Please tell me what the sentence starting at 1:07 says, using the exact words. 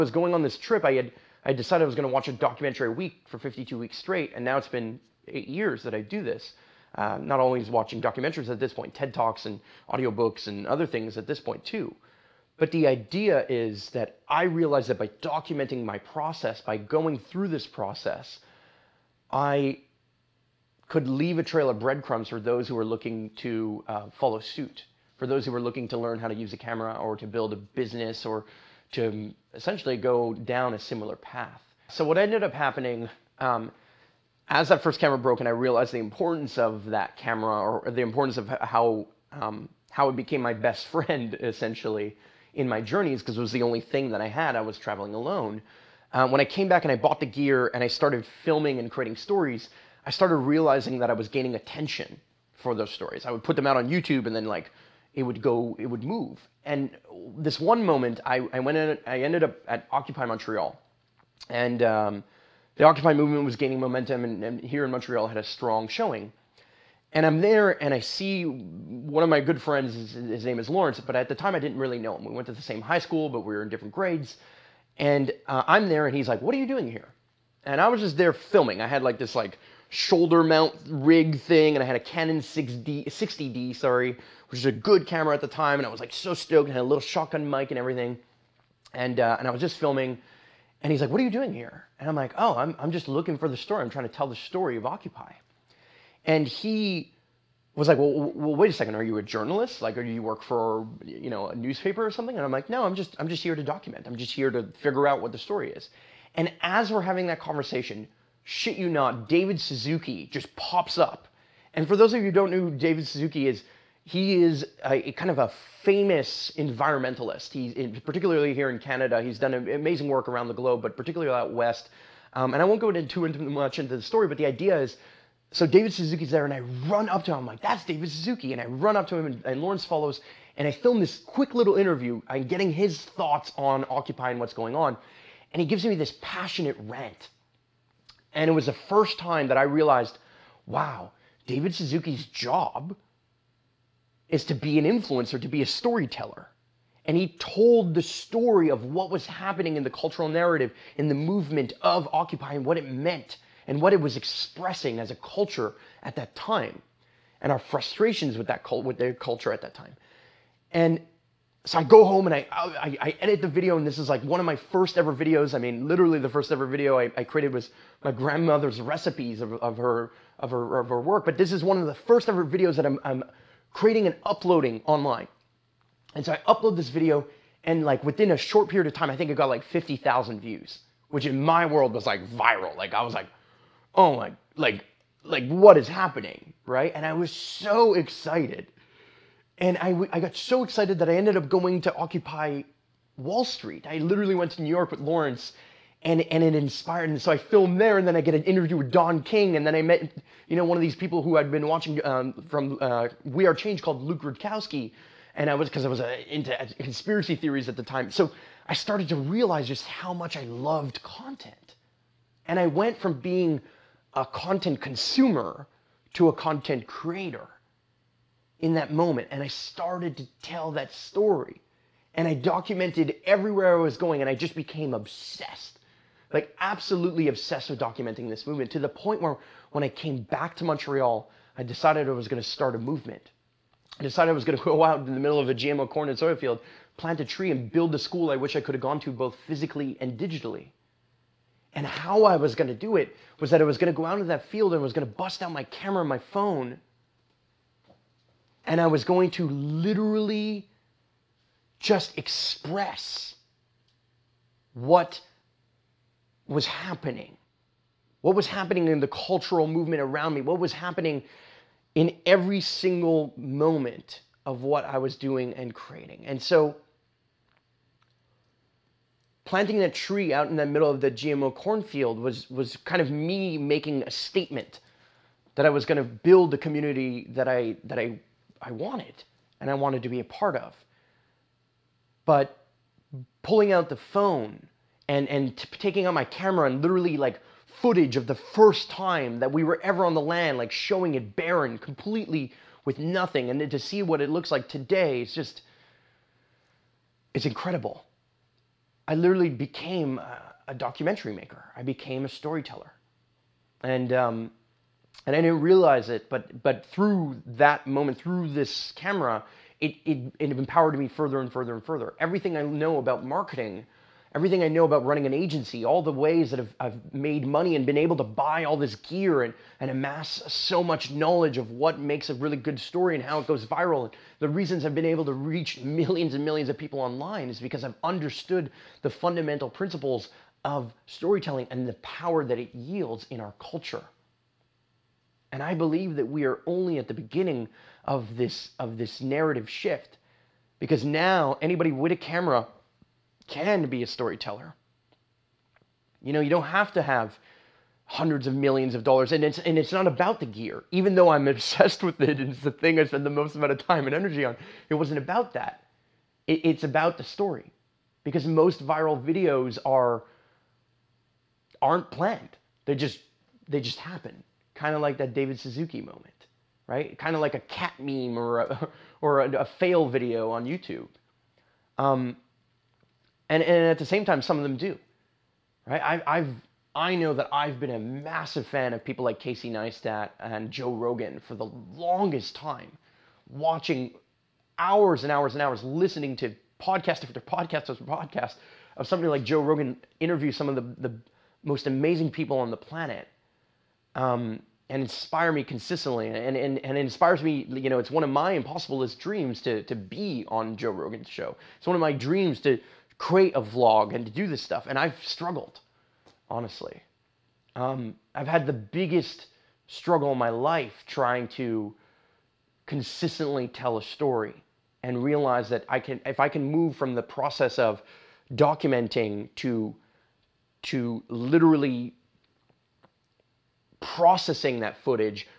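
And I'm there, and I see one of my good friends.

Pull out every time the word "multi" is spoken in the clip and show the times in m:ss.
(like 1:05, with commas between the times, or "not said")
not said.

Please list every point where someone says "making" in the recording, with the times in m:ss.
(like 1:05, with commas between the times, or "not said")
4:33.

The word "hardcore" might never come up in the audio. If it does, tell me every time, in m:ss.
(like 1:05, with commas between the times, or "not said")
not said.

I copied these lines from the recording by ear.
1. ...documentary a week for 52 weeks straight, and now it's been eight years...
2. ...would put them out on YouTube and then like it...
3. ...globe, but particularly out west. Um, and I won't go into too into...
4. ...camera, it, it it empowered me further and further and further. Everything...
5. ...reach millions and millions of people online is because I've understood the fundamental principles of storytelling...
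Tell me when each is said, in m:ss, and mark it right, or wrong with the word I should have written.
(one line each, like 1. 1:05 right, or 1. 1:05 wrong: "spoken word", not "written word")
1. 0:02 right
2. 0:53 right
3. 2:00 right
4. 5:08 right
5. 5:25 right.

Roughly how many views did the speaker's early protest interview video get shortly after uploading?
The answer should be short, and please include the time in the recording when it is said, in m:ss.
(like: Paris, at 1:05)
50,000, at 2:59.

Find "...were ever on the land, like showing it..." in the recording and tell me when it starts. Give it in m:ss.
4:49.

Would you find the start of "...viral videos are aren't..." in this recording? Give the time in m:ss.
5:58.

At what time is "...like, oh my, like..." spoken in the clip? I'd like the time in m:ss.
3:03.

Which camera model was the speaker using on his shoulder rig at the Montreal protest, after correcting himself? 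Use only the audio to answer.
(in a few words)
Canon 60D.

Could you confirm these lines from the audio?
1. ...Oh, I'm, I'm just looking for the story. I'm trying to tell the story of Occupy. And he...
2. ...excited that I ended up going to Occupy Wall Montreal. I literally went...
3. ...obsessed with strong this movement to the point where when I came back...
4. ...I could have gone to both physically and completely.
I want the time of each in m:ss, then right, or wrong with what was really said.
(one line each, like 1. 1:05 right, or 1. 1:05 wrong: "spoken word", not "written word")
1. 1:32 right
2. 3:10 wrong: "Street", not "Montreal"
3. 3:47 wrong: "documenting", not "strong"
4. 3:58 wrong: "digitally", not "completely".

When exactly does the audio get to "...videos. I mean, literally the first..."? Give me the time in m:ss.
2:45.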